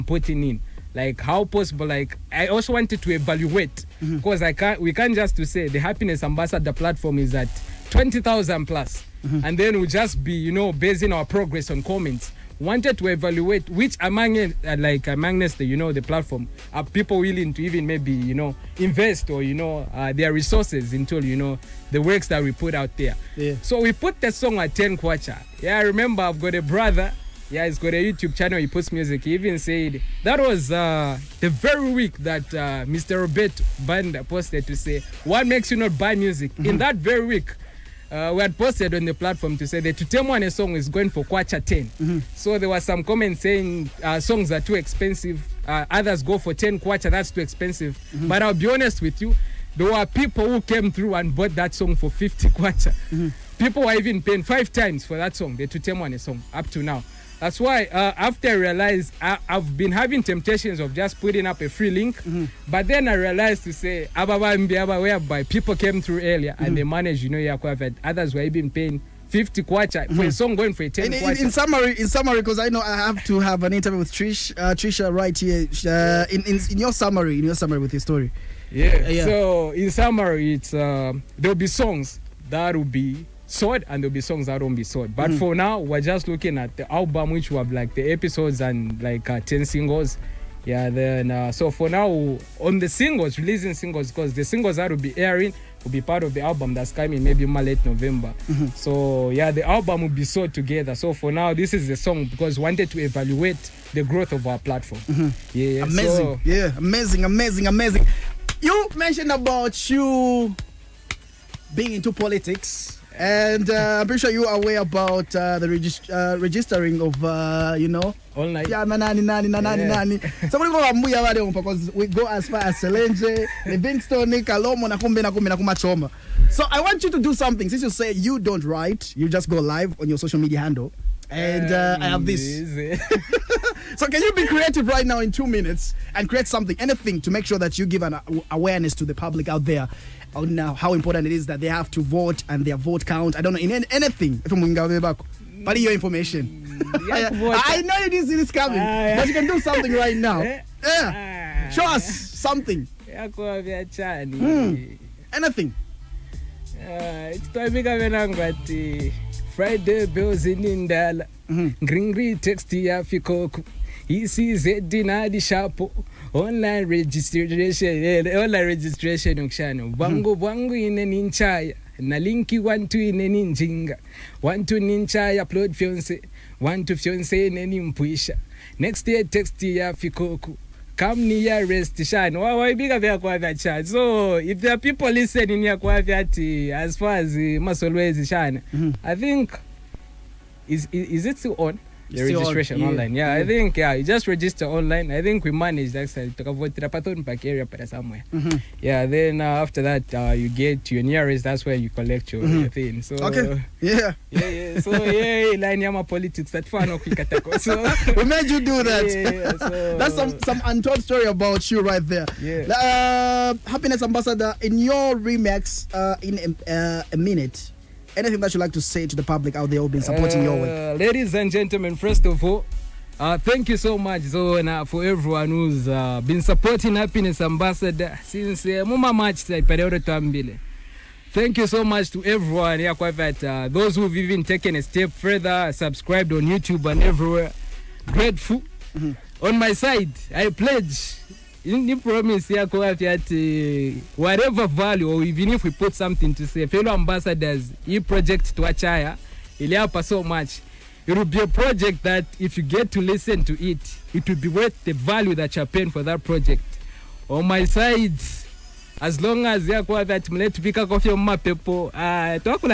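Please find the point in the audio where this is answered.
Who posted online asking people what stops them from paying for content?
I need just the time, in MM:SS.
00:33.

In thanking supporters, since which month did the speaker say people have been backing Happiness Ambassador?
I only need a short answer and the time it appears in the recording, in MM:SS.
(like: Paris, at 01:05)
March, at 03:49.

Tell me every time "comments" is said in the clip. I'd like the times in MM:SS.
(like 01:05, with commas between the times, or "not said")
00:11, 00:43.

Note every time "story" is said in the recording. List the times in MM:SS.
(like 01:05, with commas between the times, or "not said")
01:17, 03:31.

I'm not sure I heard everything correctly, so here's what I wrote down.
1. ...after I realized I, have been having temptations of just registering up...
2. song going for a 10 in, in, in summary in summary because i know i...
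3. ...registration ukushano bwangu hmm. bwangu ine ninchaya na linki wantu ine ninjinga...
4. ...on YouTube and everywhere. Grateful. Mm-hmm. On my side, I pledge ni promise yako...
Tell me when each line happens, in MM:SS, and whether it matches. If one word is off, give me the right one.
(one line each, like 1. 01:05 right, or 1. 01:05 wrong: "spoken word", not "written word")
1. 00:58 wrong: "putting", not "registering"
2. 01:10 right
3. 02:48 right
4. 03:56 right.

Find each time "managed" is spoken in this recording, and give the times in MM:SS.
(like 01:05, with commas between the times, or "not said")
01:06, 03:15.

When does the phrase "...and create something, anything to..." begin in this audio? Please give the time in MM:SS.
02:16.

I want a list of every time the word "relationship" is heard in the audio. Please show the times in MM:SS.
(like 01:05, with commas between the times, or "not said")
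not said.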